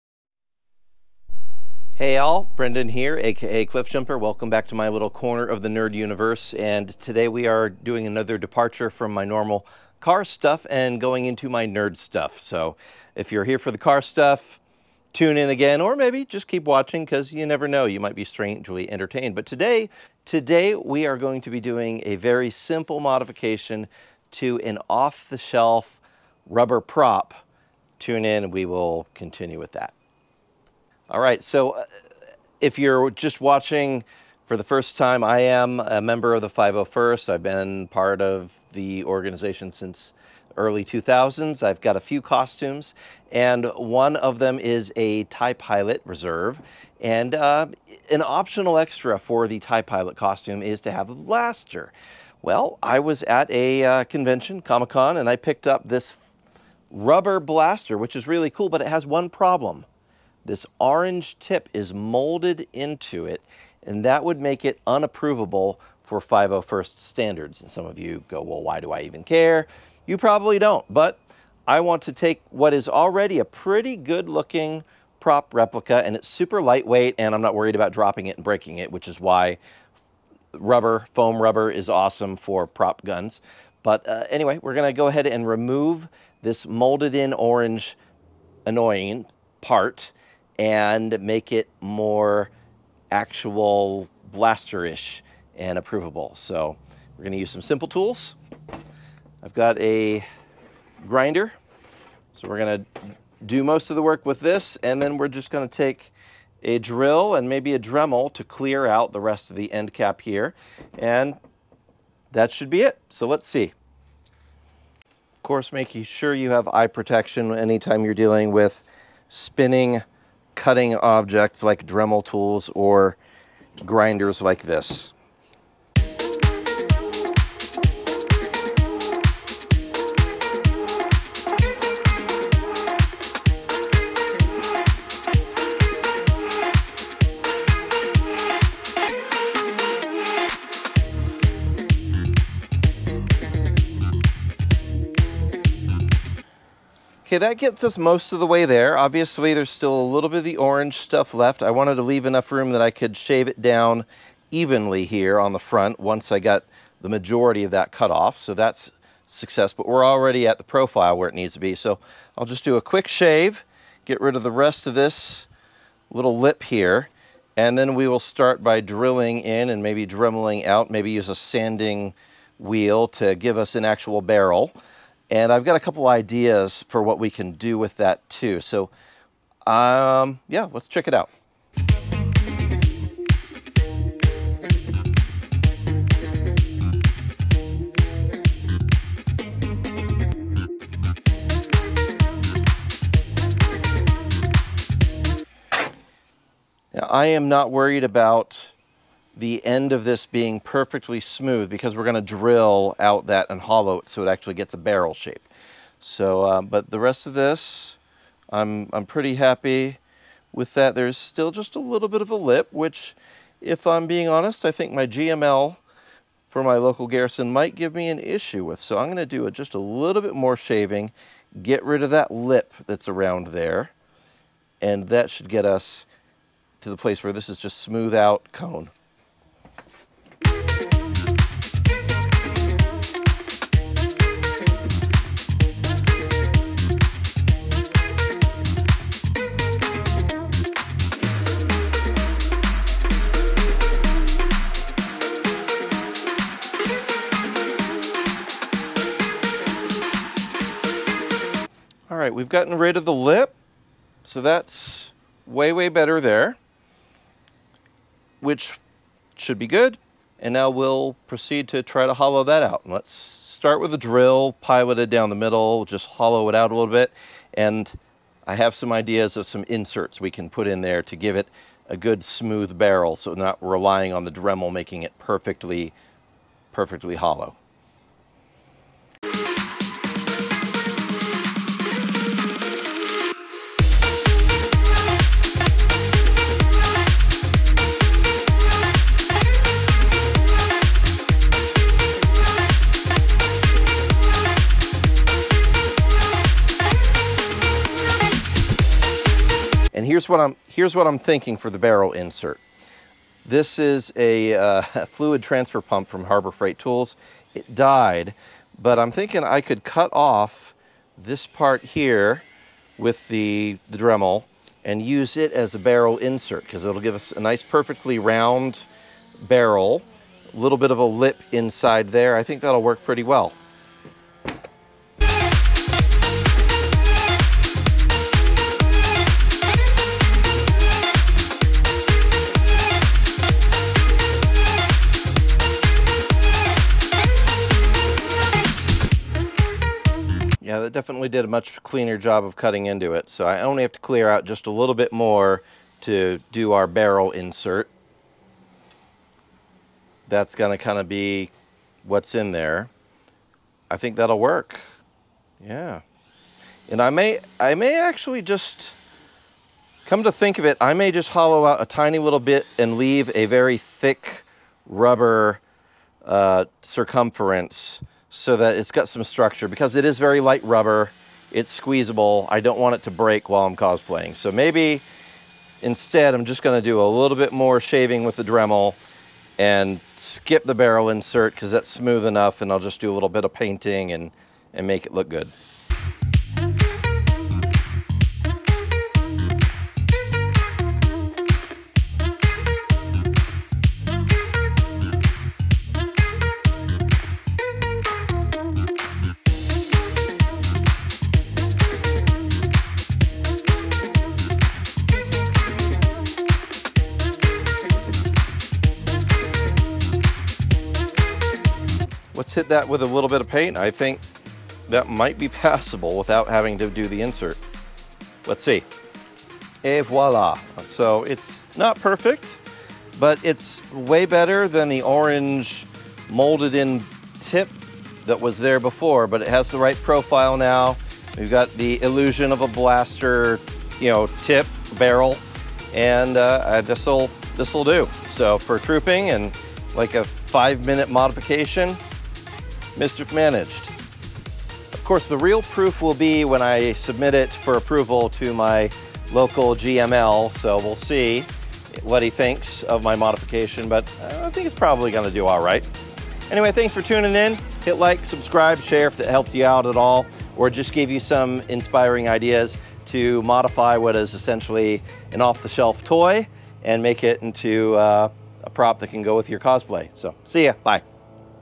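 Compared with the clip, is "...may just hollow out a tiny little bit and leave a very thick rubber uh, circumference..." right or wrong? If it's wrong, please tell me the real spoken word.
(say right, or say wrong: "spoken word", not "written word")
right.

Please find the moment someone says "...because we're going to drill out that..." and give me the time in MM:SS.
03:21.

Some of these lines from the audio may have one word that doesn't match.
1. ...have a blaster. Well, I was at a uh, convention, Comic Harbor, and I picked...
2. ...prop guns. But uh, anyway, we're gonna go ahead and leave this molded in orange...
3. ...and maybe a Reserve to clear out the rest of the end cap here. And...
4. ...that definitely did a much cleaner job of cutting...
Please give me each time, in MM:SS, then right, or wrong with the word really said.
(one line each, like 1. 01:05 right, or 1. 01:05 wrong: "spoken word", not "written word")
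1. 00:50 wrong: "Con", not "Harbor"
2. 01:22 wrong: "remove", not "leave"
3. 01:47 wrong: "Dremel", not "Reserve"
4. 05:40 right.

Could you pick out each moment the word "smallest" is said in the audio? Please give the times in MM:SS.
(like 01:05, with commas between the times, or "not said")
not said.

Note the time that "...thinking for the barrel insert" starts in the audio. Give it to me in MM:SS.
05:01.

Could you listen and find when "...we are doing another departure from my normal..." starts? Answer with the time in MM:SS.
00:07.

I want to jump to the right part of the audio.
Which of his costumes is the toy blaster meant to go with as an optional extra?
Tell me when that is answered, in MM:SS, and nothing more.
00:45.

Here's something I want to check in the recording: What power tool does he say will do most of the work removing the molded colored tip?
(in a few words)
grinder.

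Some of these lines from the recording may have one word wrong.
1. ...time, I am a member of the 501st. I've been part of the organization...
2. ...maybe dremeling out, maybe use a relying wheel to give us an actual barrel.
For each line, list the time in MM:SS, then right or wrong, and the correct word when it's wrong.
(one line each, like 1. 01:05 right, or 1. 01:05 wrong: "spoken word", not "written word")
1. 00:34 right
2. 02:49 wrong: "sanding", not "relying".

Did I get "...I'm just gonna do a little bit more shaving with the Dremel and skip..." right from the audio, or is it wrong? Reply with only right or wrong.
right.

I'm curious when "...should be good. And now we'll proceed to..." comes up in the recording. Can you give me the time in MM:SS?
04:19.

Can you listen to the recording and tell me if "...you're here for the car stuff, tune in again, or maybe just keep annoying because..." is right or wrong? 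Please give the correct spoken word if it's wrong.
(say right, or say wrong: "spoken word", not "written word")
wrong: "watching", not "annoying".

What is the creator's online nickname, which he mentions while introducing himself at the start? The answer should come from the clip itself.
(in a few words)
Cliffjumper.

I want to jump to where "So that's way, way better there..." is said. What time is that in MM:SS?
04:14.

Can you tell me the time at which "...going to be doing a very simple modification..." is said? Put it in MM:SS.
00:21.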